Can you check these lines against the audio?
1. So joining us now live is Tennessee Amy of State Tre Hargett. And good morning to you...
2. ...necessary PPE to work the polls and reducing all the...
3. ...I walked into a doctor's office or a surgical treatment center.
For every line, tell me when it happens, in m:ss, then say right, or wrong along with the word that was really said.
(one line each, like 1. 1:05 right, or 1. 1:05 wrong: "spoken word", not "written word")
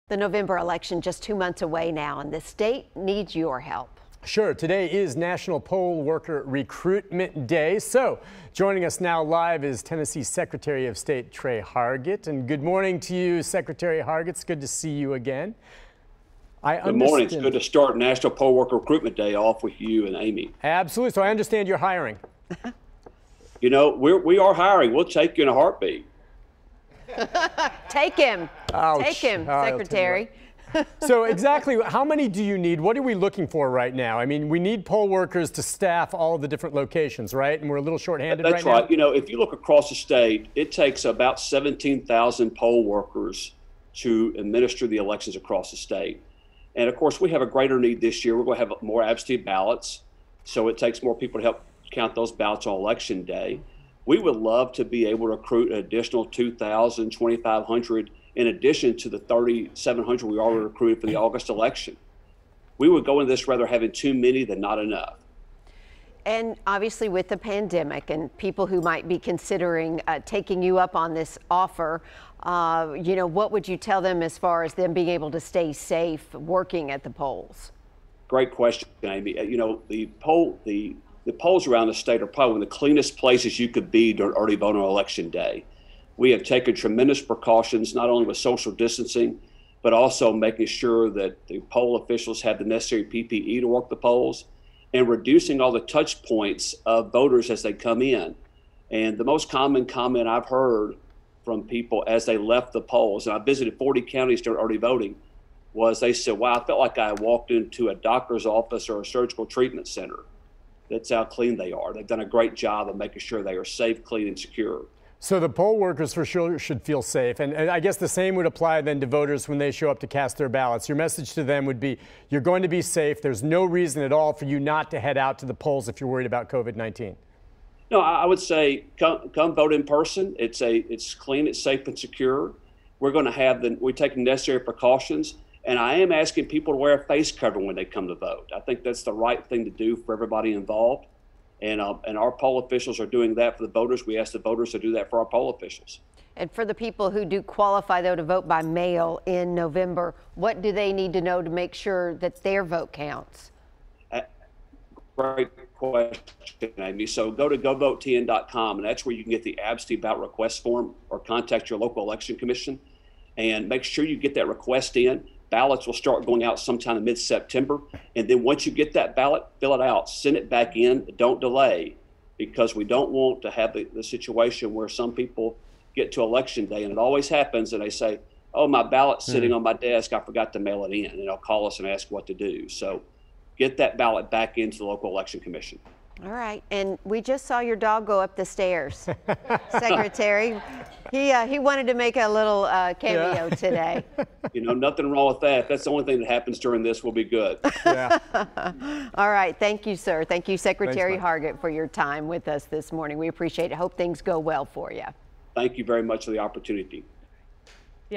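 1. 0:07 wrong: "Secretary", not "Amy"
2. 1:32 right
3. 1:46 right.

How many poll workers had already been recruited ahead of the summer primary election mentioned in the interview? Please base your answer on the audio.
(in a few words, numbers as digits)
3,700.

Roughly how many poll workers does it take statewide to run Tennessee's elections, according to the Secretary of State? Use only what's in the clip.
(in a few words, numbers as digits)
17,000.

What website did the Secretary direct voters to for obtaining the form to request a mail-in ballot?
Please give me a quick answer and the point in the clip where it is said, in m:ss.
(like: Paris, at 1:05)
govotetn.com, at 2:37.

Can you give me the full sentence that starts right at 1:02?
We would go into this rather having too many than not enough.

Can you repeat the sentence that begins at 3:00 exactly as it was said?
I forgot to mail it in," and they'll call us and ask what to do.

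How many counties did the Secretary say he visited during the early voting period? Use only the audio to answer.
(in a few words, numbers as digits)
40.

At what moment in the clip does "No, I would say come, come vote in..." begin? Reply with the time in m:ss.
2:07.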